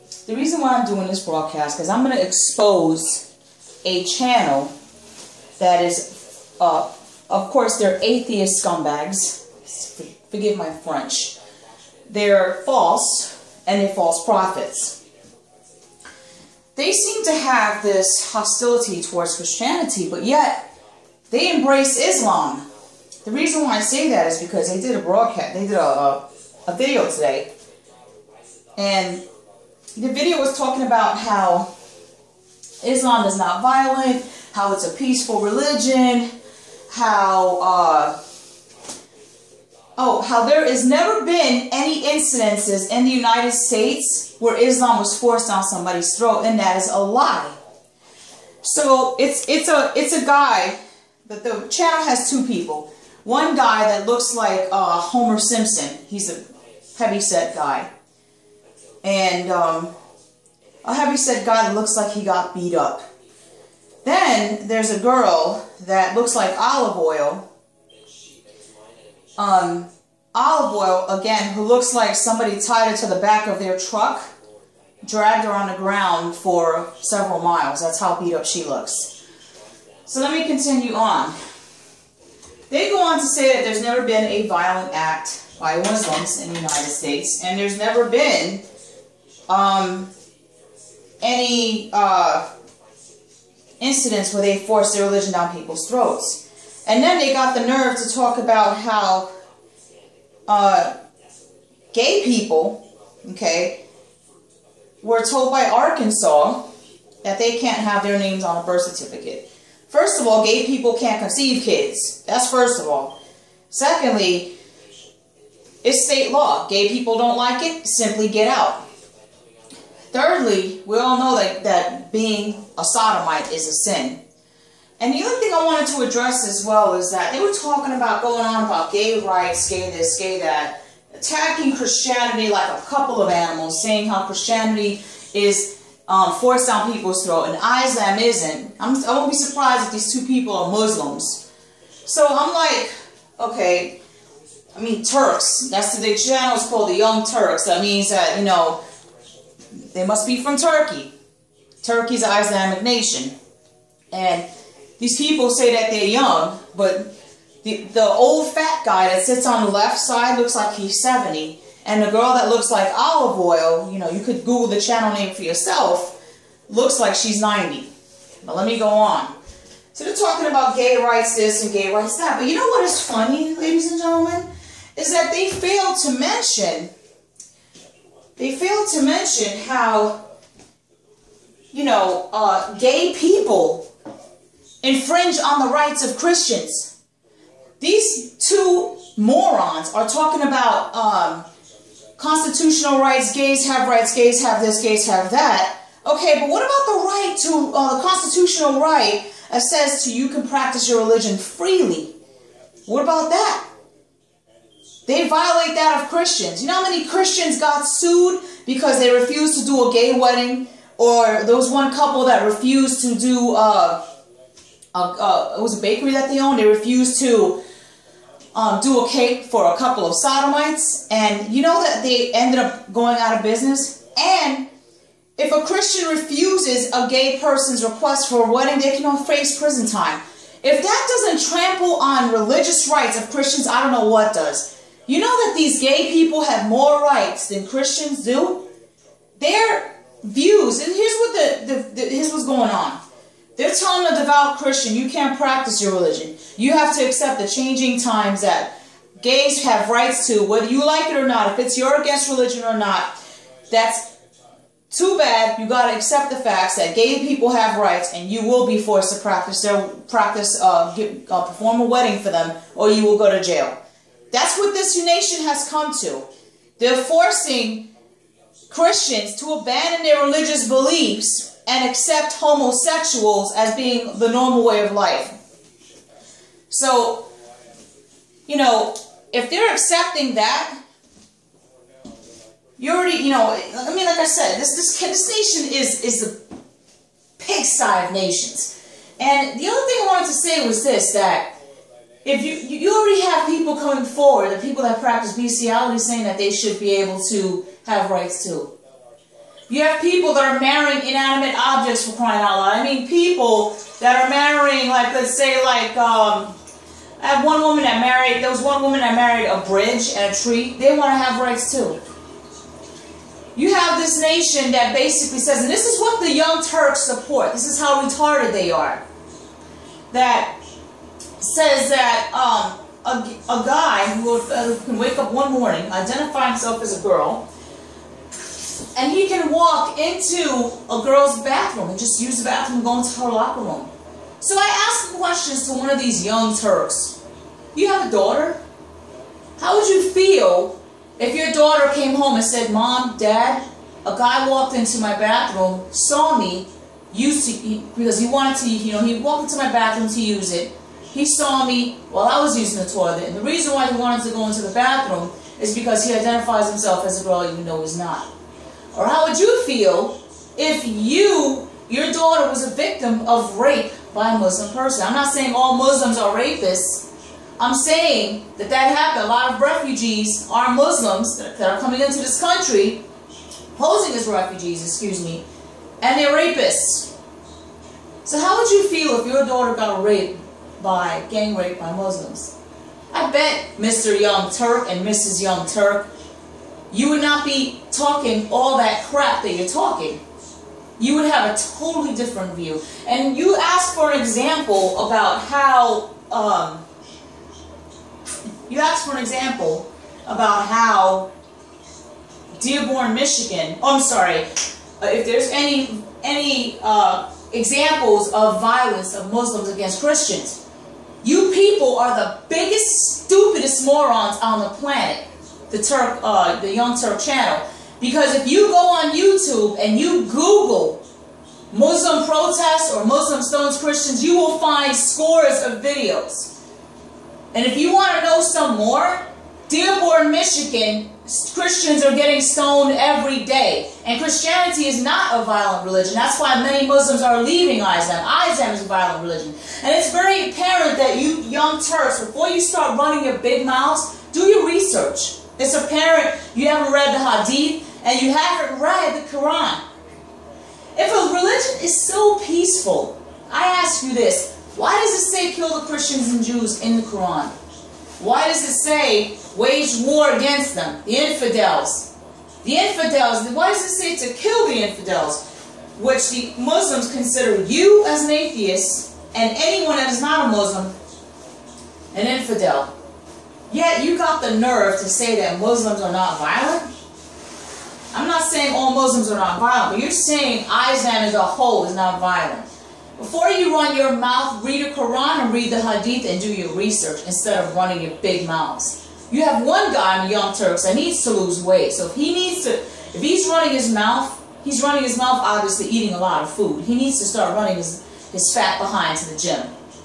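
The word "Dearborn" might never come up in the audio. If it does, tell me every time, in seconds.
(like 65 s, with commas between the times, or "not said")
402 s, 429 s.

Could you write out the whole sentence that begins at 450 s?
If a religion is so peaceful, I ask you this, why does it say kill the Christians and Jews in the Quran?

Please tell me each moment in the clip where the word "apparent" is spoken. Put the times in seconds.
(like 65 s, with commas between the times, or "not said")
440 s, 445 s.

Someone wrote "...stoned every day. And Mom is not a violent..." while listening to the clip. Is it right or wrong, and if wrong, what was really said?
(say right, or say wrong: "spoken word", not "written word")
wrong: "Christianity", not "Mom".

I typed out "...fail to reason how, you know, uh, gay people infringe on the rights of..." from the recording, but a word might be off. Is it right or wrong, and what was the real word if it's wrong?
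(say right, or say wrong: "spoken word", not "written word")
wrong: "mention", not "reason".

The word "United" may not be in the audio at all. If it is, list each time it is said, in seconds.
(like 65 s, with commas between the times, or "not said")
43 s, 86 s.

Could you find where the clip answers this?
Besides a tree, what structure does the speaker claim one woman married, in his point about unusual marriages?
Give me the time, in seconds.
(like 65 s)
309 s.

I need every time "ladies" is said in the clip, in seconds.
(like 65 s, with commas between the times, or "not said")
173 s.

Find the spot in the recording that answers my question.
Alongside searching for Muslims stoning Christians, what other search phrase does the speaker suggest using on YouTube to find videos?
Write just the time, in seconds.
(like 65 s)
421 s.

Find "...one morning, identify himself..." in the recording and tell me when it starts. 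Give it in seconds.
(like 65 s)
325 s.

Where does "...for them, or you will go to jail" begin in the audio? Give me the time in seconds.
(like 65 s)
262 s.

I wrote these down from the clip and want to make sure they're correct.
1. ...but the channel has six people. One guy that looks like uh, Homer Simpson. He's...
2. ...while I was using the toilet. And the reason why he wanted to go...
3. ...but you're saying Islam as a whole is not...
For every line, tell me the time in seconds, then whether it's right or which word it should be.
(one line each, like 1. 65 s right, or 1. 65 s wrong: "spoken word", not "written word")
1. 51 s wrong: "two", not "six"
2. 352 s right
3. 479 s right.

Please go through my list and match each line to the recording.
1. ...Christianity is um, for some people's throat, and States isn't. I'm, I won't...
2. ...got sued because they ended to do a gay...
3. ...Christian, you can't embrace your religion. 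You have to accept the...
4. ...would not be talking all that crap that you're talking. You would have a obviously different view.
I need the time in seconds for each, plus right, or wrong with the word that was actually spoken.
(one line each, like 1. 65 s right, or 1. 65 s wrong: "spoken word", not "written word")
1. 134 s wrong: "Islam", not "States"
2. 207 s wrong: "refused", not "ended"
3. 244 s wrong: "practice", not "embrace"
4. 387 s wrong: "totally", not "obviously".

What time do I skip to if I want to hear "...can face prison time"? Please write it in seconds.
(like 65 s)
228 s.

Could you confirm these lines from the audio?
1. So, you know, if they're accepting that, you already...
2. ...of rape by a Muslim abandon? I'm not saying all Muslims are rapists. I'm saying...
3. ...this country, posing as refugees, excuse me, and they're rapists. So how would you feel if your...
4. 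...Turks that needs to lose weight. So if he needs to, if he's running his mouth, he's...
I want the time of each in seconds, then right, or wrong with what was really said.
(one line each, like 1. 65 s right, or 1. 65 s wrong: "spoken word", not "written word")
1. 276 s right
2. 363 s wrong: "person", not "abandon"
3. 372 s right
4. 490 s right.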